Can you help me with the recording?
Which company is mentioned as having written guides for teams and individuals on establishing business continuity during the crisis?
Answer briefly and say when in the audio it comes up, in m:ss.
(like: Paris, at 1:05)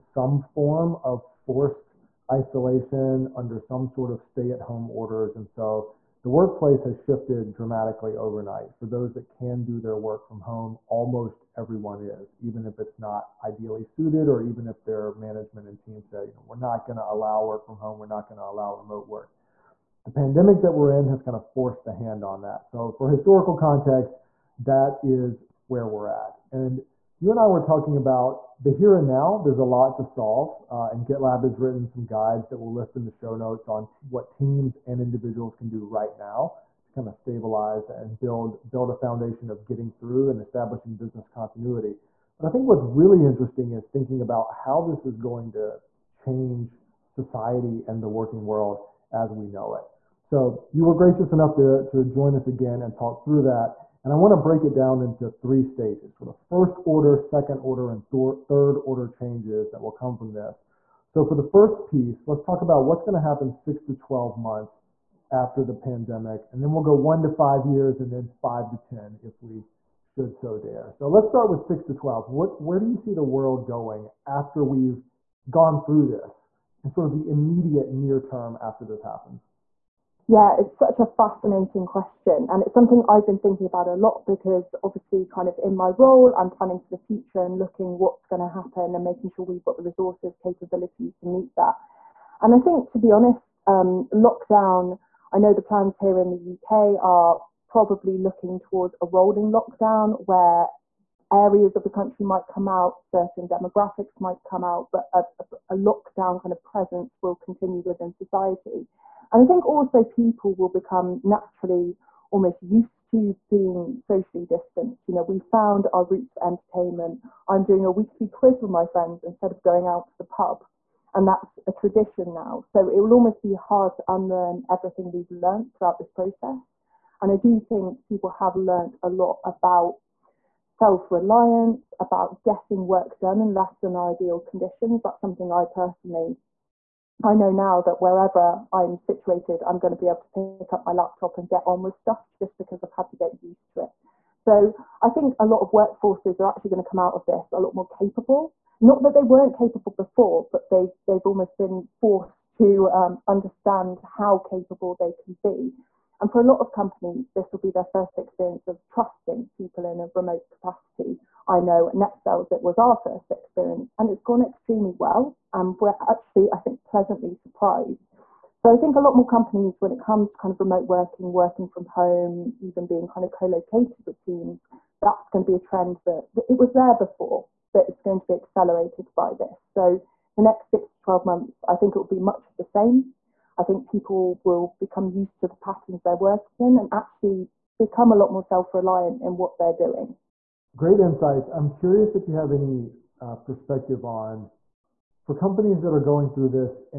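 GitLab, at 0:31.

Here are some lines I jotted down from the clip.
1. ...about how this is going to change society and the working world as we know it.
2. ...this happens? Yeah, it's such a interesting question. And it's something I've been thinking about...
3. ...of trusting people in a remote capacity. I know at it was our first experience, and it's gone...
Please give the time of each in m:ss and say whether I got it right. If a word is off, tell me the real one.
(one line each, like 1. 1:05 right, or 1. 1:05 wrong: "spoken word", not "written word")
1. 0:44 right
2. 1:18 wrong: "fascinating", not "interesting"
3. 2:38 right.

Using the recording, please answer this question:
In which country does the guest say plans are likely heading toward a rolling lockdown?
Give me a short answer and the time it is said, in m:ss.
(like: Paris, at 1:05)
UK, at 1:36.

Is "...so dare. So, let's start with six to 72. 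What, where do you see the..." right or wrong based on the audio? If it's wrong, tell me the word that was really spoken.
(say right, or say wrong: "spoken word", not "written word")
wrong: "12", not "72".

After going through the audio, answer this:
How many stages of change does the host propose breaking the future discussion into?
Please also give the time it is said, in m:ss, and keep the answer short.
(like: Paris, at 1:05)
3, at 0:55.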